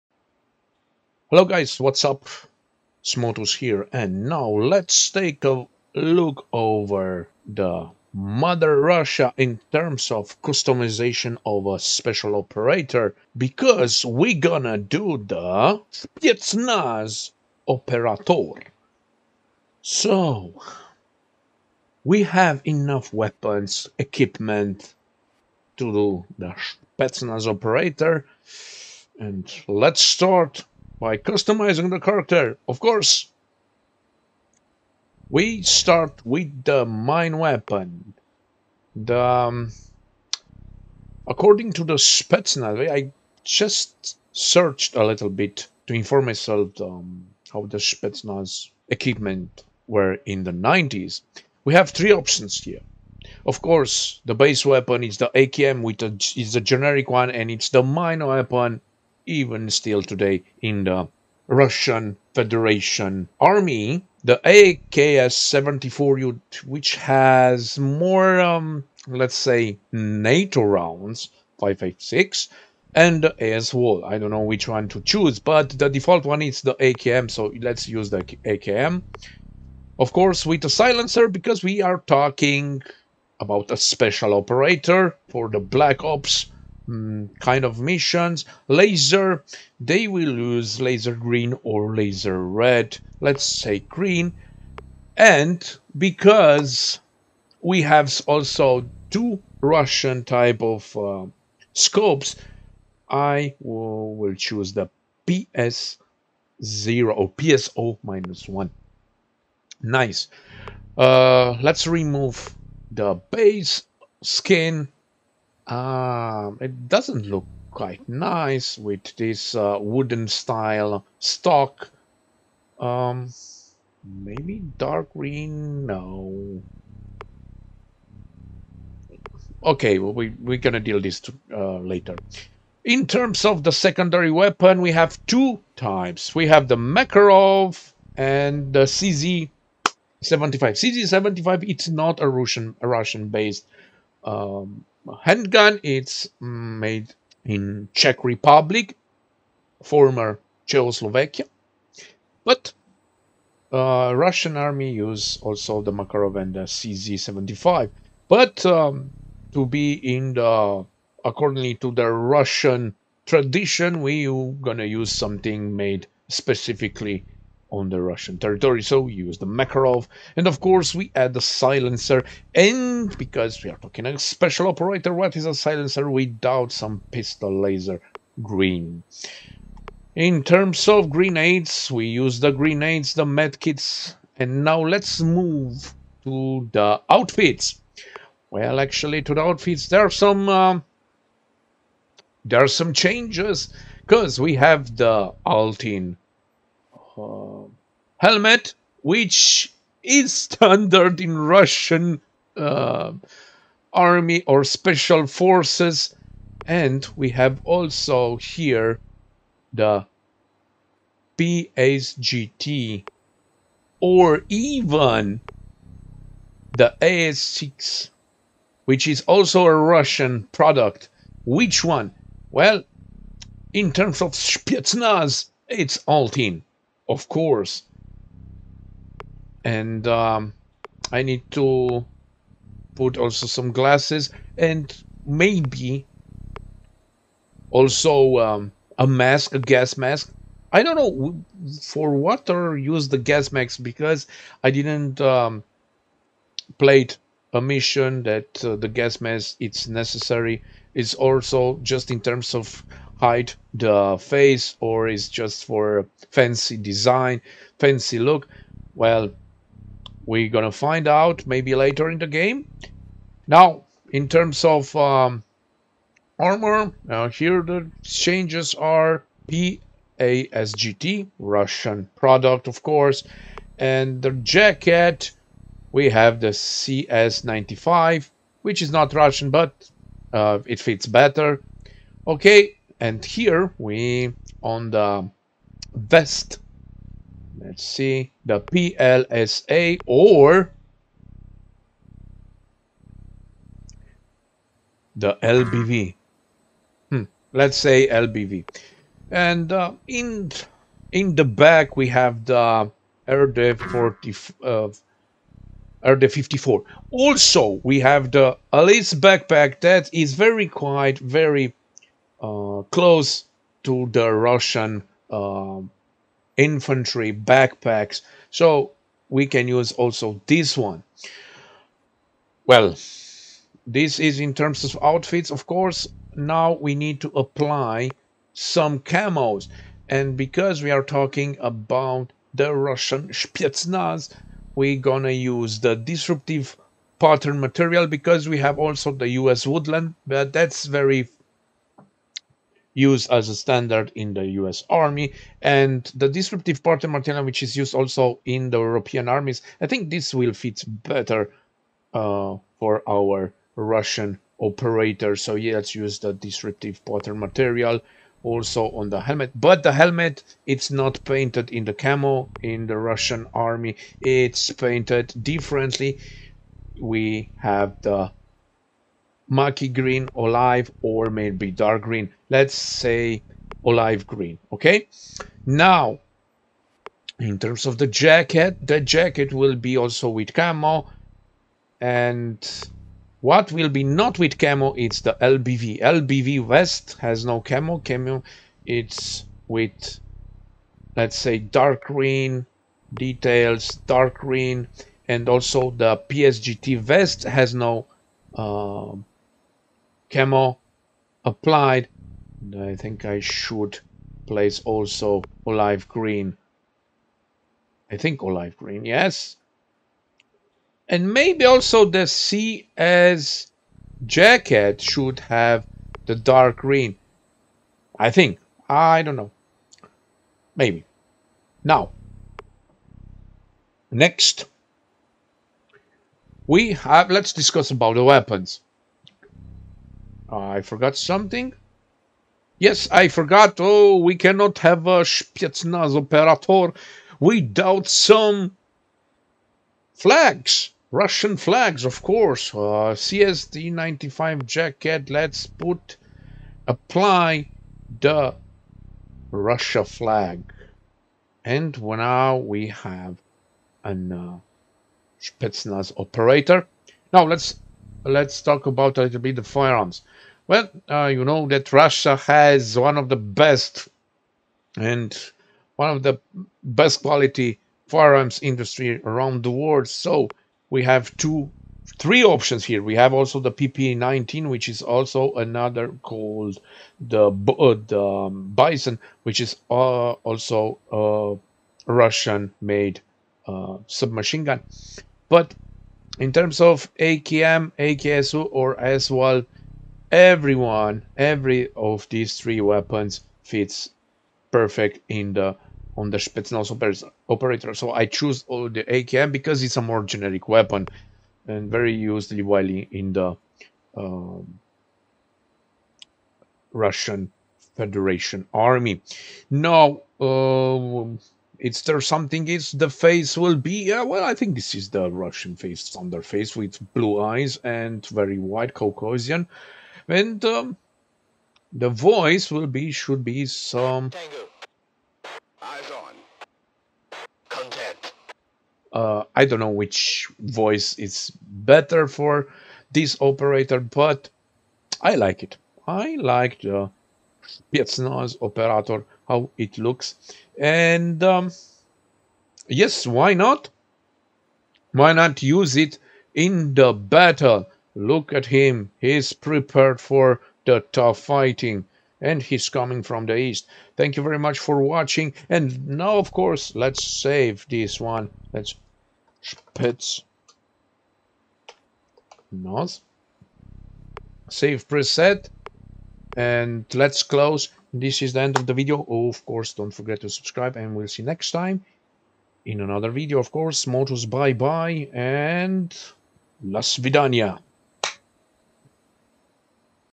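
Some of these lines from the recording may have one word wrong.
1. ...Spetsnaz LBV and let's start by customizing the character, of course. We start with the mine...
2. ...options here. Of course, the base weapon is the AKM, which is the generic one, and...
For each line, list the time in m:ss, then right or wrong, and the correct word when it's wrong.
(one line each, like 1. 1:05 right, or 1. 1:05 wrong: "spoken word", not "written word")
1. 0:26 wrong: "Operator", not "LBV"
2. 0:52 right.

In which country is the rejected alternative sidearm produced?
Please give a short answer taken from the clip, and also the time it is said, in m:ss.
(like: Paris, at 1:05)
Czech Republic, at 2:27.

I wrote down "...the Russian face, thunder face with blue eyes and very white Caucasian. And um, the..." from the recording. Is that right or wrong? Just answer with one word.
right.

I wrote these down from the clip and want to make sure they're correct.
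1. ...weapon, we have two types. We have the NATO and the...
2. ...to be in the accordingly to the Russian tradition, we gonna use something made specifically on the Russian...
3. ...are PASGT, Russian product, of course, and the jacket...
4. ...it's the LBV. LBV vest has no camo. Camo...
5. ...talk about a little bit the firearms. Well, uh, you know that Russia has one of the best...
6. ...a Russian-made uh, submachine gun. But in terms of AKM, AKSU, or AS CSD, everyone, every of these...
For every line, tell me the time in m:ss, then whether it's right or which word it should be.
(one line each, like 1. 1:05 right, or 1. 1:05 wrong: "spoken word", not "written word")
1. 2:14 wrong: "Makarov", not "NATO"
2. 2:39 right
3. 4:28 right
4. 6:24 right
5. 7:38 right
6. 8:02 wrong: "Val", not "CSD".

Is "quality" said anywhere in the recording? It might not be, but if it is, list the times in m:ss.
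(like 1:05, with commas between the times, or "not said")
7:47.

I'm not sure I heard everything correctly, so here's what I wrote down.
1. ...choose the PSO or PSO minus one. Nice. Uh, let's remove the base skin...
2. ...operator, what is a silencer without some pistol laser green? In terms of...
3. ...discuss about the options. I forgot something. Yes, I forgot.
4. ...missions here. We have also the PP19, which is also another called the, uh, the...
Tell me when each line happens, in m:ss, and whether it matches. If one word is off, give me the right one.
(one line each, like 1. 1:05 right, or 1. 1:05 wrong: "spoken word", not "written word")
1. 1:44 right
2. 2:54 right
3. 7:07 wrong: "weapons", not "options"
4. 7:52 wrong: "options", not "missions".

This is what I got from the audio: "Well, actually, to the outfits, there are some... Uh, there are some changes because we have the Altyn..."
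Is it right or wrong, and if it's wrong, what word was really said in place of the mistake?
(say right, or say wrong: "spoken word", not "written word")
right.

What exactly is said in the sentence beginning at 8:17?
So I choose all the AKM because it's a more generic weapon and very used while in the um, Russian Federation Army.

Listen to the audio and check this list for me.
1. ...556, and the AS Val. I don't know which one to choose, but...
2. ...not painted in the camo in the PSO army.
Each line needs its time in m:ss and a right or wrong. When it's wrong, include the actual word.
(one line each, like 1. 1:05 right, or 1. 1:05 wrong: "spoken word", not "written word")
1. 1:11 right
2. 6:00 wrong: "Russian", not "PSO".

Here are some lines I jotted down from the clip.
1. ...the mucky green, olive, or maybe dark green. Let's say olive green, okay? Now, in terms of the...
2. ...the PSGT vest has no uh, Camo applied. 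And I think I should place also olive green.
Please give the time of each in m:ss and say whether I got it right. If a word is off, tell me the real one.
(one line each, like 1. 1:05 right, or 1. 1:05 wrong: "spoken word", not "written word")
1. 6:08 right
2. 6:35 right.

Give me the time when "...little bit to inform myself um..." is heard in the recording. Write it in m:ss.
0:45.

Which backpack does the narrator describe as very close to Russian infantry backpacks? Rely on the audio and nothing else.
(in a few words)
Alice backpack.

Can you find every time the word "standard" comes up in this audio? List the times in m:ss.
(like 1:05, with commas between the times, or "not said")
3:20, 5:43.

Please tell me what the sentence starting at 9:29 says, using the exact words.
Oh, of course, don't forget to subscribe and we'll see next time in another video, of course.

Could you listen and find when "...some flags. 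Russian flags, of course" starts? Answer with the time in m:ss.
7:18.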